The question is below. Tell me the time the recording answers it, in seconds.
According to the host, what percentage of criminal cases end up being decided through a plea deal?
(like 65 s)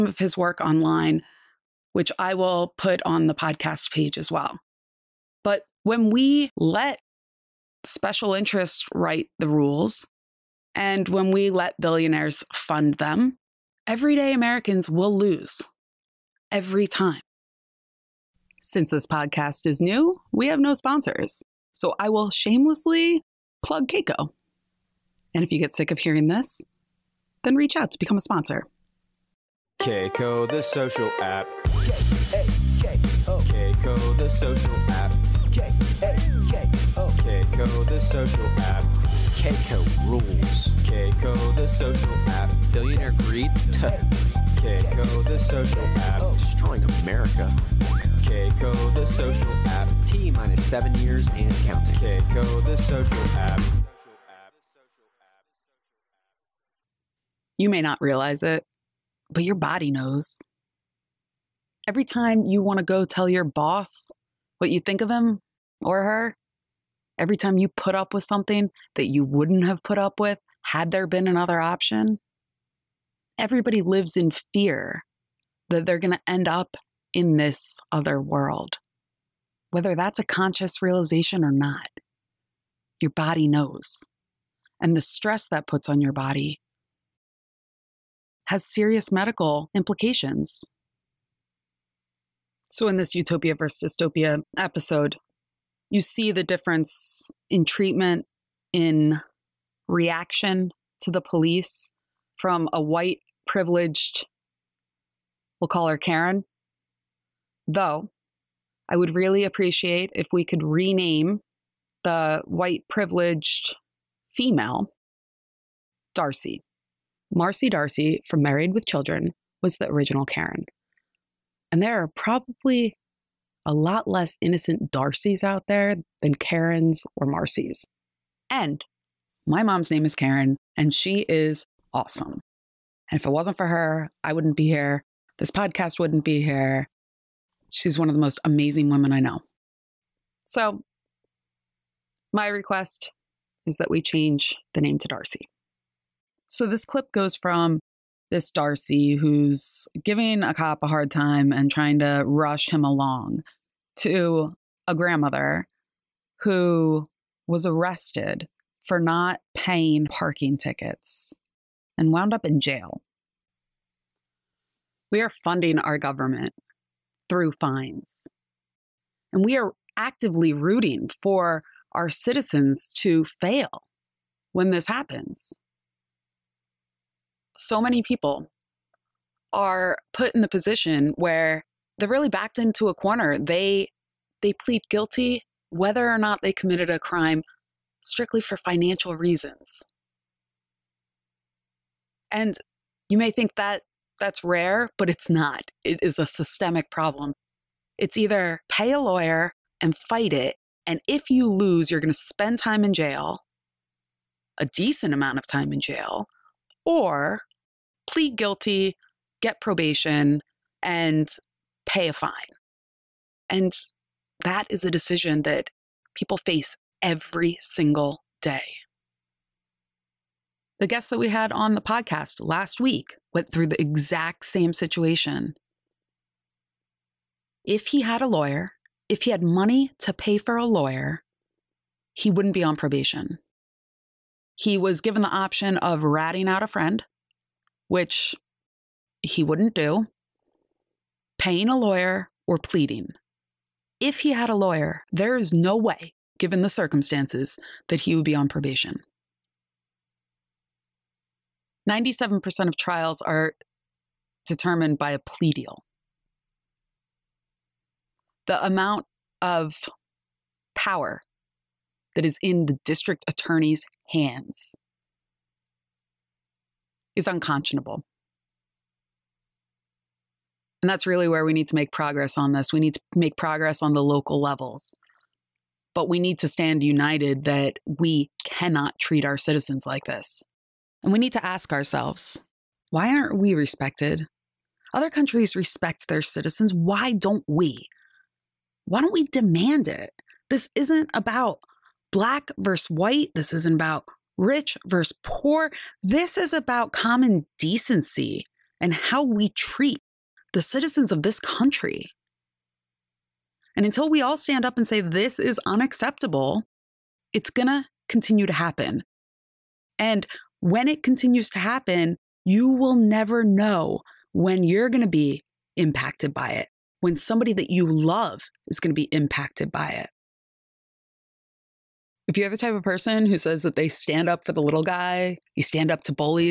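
251 s.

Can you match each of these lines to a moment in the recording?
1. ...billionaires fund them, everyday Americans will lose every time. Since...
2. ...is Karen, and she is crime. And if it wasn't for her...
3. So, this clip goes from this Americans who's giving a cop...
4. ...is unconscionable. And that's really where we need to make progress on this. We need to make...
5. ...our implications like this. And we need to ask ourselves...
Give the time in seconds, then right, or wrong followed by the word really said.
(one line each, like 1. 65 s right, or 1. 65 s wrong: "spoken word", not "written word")
1. 11 s right
2. 130 s wrong: "awesome", not "crime"
3. 146 s wrong: "Darcy", not "Americans"
4. 267 s right
5. 279 s wrong: "citizens", not "implications".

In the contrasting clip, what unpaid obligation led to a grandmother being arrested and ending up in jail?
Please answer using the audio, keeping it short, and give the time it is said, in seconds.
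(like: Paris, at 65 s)
Parking tickets, at 160 s.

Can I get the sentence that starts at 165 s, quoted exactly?
We are funding our government through fines.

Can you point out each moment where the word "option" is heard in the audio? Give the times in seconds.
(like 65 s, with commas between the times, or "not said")
71 s, 235 s.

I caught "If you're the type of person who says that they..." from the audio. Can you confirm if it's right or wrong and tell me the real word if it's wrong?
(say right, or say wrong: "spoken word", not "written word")
right.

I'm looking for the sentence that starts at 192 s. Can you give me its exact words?
And you may think that that's rare, but it's not.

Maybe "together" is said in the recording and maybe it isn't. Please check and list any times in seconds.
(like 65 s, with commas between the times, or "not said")
not said.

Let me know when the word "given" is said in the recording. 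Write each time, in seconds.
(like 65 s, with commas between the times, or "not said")
235 s, 246 s.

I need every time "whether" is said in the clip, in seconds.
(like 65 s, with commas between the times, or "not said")
79 s, 185 s.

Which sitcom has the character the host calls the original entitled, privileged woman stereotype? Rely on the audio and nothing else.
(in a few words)
Married with Children.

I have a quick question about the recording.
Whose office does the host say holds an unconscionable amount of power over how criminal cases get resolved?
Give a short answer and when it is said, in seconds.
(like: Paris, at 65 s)
District attorney, at 262 s.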